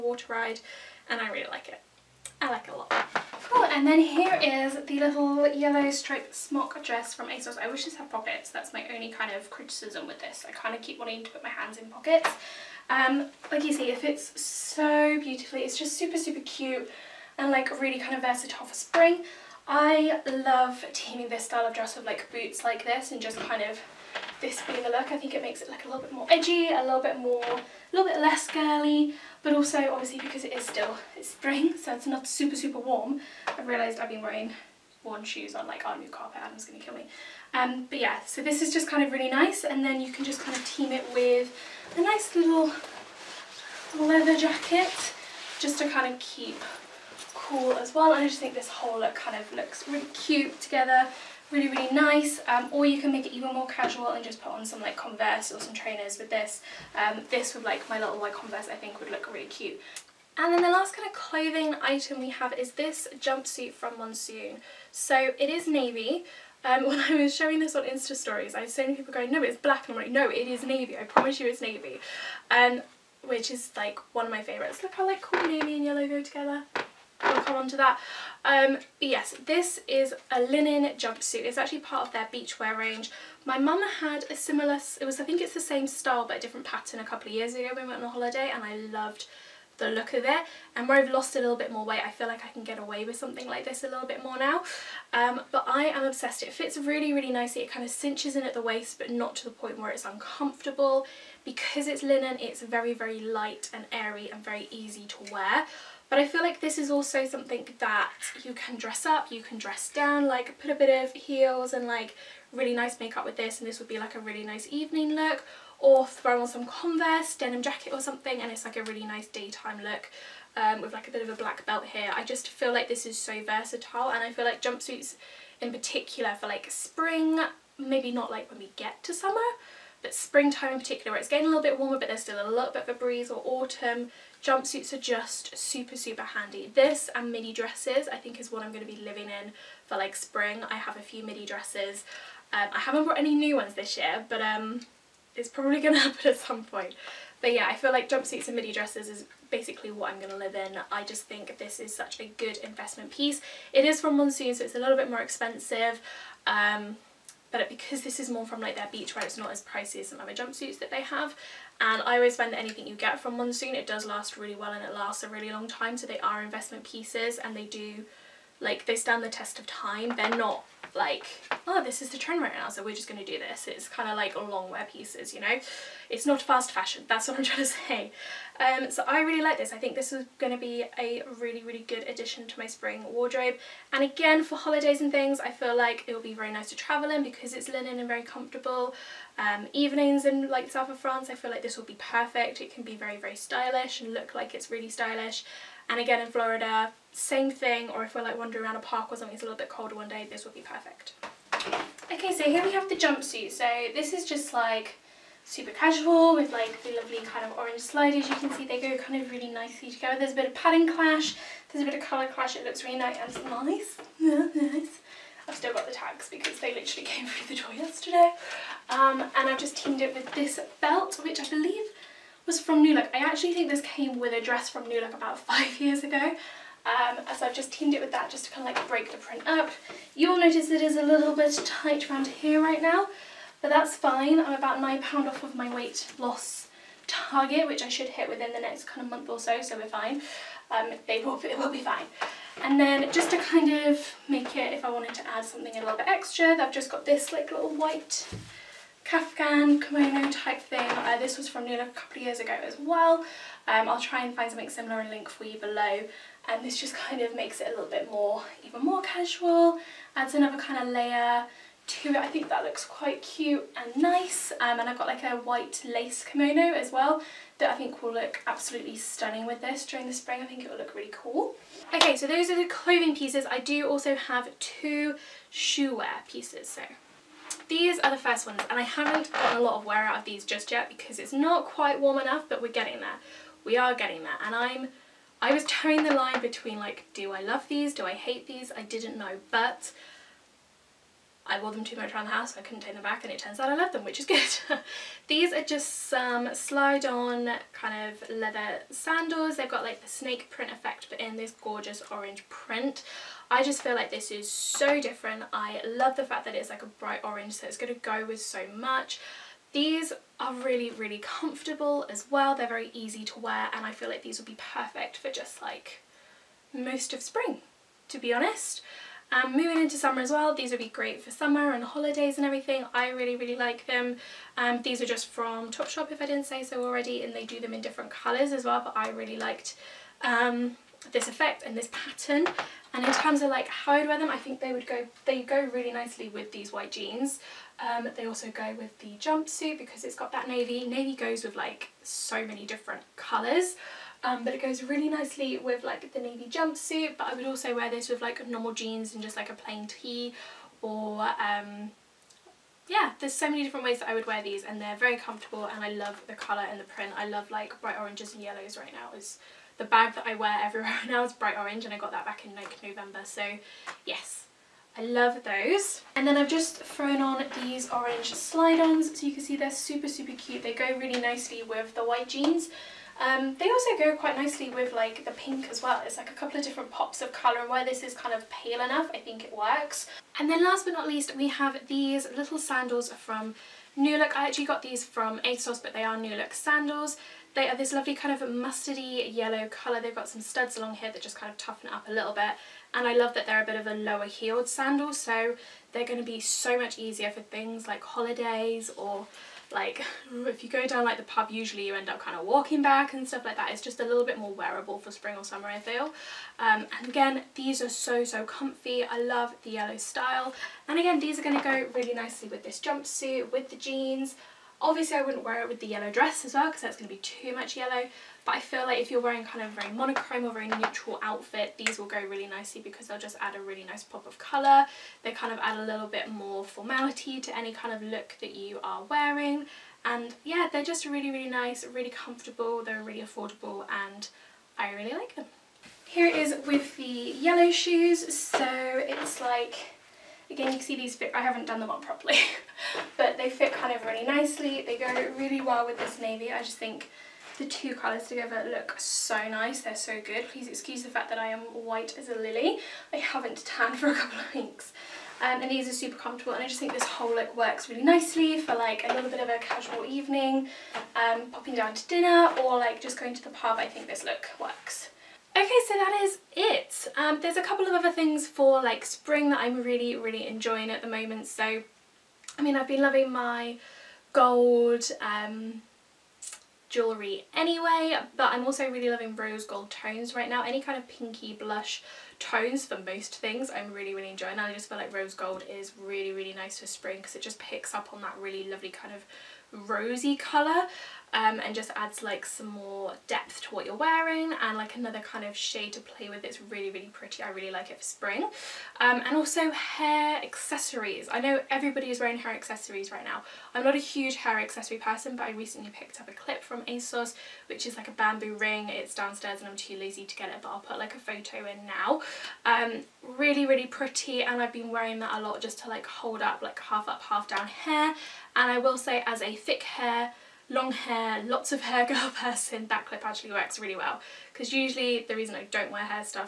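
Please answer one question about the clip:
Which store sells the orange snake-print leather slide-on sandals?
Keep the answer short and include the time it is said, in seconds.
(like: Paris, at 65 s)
Topshop, at 325 s.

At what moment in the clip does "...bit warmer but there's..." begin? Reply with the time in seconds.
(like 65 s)
131 s.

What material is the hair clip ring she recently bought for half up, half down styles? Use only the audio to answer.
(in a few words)
Bamboo.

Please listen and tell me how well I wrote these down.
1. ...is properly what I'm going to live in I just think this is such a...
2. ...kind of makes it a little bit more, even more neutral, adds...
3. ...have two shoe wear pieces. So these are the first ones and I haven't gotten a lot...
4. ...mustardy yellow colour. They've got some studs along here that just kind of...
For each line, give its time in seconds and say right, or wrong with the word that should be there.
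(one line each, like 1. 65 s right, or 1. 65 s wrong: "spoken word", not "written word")
1. 149 s wrong: "basically", not "properly"
2. 257 s wrong: "casual", not "neutral"
3. 274 s right
4. 388 s right.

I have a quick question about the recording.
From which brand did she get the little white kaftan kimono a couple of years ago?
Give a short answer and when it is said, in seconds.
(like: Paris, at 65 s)
Nula, at 251 s.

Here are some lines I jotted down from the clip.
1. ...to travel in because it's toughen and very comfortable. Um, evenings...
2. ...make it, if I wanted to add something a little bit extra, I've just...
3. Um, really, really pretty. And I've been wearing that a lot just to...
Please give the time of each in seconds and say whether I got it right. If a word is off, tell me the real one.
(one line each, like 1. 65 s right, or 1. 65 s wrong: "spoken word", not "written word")
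1. 186 s wrong: "linen", not "toughen"
2. 244 s right
3. 512 s right.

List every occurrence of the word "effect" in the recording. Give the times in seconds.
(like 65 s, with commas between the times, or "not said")
300 s, 331 s.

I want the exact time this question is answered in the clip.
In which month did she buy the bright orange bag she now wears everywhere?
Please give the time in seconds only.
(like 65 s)
362 s.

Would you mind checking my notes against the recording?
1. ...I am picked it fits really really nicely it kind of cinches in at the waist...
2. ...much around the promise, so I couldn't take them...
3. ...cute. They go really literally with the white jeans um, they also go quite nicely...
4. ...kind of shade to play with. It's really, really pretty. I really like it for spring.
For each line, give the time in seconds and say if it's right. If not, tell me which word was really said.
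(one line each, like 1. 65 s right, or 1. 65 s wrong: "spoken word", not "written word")
1. 95 s wrong: "obsessed", not "picked"
2. 291 s wrong: "house", not "promise"
3. 370 s wrong: "nicely", not "literally"
4. 495 s right.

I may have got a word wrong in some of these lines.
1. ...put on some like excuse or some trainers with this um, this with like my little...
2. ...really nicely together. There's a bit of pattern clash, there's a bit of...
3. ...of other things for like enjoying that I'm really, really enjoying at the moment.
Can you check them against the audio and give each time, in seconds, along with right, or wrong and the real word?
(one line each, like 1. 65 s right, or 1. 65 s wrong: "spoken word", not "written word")
1. 54 s wrong: "converse", not "excuse"
2. 209 s right
3. 467 s wrong: "spring", not "enjoying".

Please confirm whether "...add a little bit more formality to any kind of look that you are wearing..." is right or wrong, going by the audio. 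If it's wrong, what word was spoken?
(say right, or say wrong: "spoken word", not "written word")
right.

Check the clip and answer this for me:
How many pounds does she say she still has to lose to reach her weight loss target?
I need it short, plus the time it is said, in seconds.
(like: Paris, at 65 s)
9, at 234 s.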